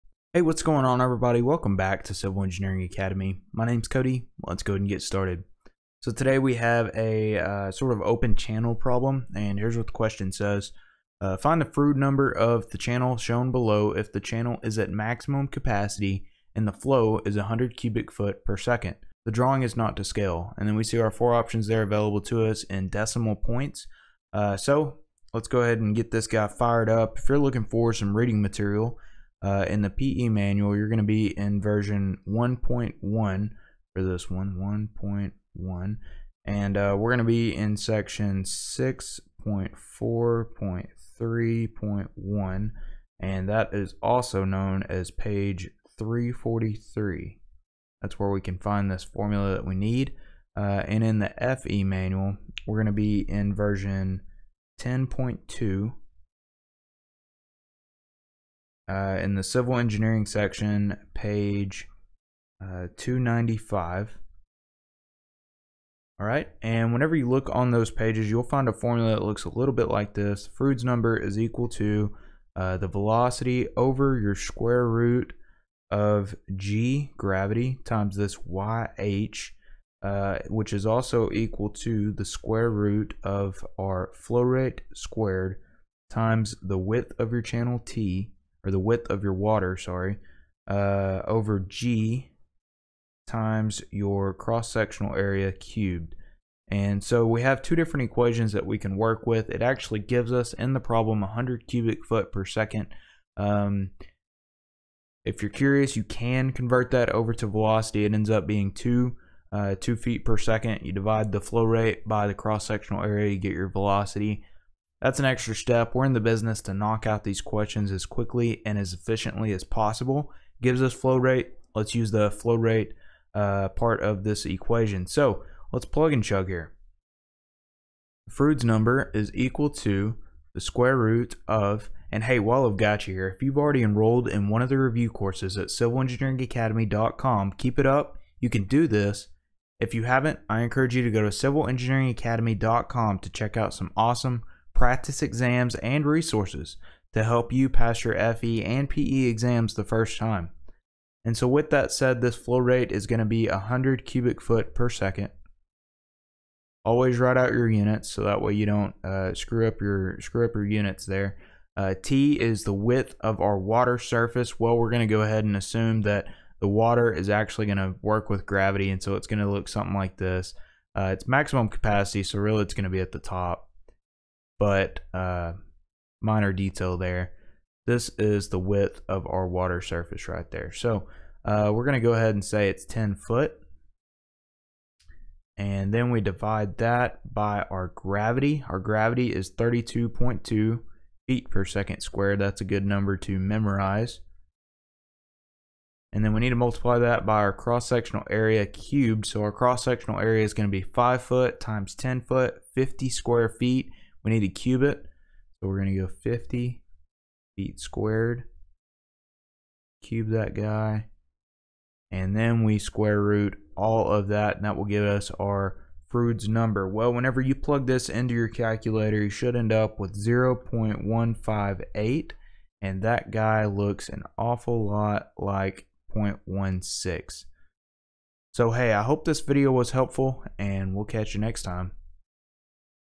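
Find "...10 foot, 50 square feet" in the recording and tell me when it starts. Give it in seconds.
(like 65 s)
201 s.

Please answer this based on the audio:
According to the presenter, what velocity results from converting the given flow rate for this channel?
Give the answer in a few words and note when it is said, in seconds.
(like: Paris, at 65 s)
2 feet per second, at 109 s.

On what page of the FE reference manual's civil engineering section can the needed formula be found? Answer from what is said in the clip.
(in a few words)
295.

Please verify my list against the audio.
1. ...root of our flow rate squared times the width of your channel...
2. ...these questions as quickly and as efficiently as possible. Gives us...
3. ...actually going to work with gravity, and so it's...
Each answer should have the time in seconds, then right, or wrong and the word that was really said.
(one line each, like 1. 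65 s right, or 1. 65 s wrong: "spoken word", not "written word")
1. 82 s right
2. 117 s right
3. 167 s right.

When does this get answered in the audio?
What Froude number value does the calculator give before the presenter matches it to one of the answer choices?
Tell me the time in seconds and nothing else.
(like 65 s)
220 s.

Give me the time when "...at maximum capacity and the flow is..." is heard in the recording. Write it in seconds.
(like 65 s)
14 s.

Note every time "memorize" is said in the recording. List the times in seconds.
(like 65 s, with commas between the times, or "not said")
193 s.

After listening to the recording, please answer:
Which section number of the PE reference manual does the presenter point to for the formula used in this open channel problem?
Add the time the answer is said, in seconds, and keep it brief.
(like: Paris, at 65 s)
6.4.3.1, at 38 s.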